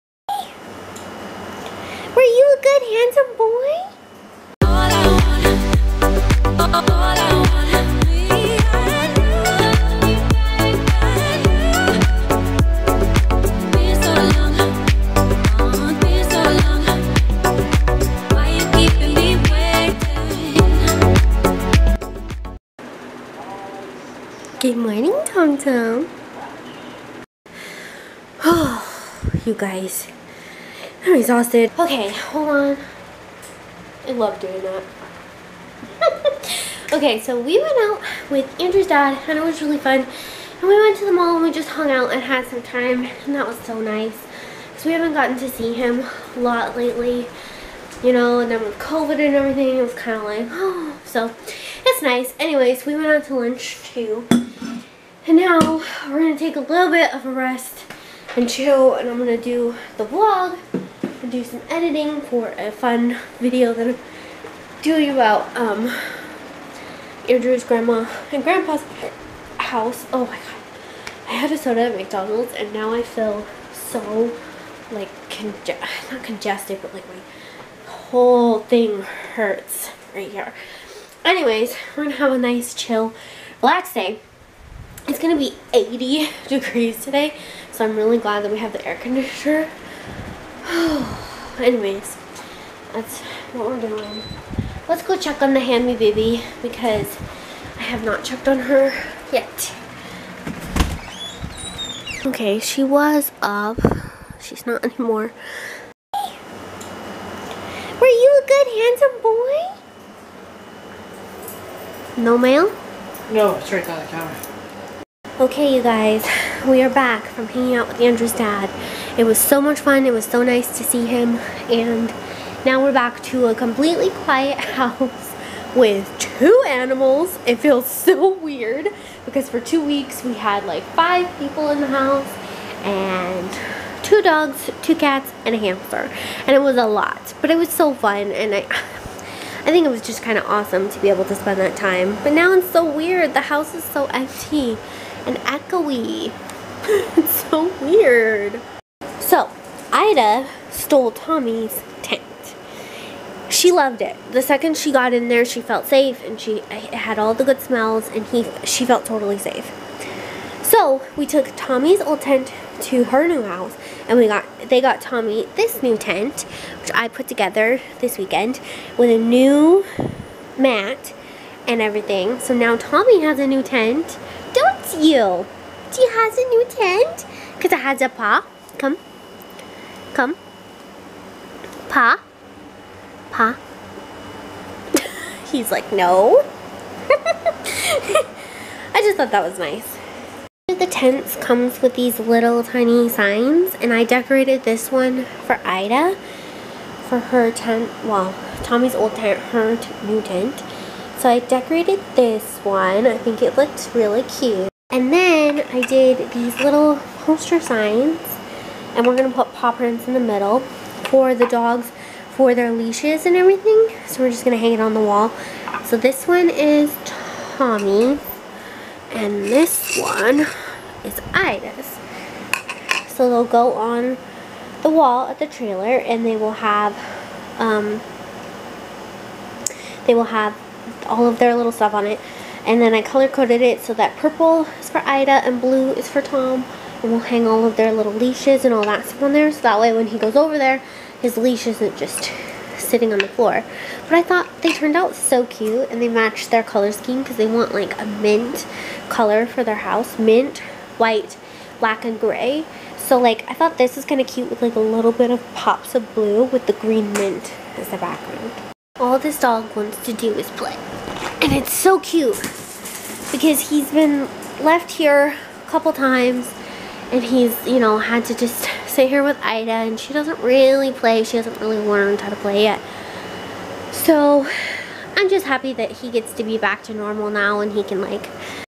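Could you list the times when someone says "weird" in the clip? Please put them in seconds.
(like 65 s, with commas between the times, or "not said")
128 s, 142 s, 147 s.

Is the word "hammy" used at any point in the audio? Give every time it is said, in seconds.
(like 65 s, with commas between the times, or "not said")
95 s.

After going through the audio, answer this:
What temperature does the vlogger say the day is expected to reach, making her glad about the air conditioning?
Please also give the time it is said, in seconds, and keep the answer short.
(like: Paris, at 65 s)
80 degrees, at 85 s.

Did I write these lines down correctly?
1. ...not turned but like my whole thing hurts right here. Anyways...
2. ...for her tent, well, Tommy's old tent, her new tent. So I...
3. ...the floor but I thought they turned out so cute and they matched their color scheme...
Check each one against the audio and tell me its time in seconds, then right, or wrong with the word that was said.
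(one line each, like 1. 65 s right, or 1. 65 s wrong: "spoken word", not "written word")
1. 76 s wrong: "congested", not "turned"
2. 197 s right
3. 243 s right.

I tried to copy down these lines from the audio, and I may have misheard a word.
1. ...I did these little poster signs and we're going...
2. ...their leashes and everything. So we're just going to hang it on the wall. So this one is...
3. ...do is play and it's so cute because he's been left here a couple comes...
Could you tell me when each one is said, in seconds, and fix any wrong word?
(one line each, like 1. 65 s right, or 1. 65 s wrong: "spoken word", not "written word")
1. 205 s right
2. 212 s right
3. 260 s wrong: "times", not "comes".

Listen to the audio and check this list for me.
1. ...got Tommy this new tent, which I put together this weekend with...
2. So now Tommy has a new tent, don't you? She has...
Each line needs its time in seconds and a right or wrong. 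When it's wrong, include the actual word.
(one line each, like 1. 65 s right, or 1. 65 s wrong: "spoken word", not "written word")
1. 164 s right
2. 172 s right.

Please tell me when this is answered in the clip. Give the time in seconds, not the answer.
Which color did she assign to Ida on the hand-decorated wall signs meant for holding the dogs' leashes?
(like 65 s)
234 s.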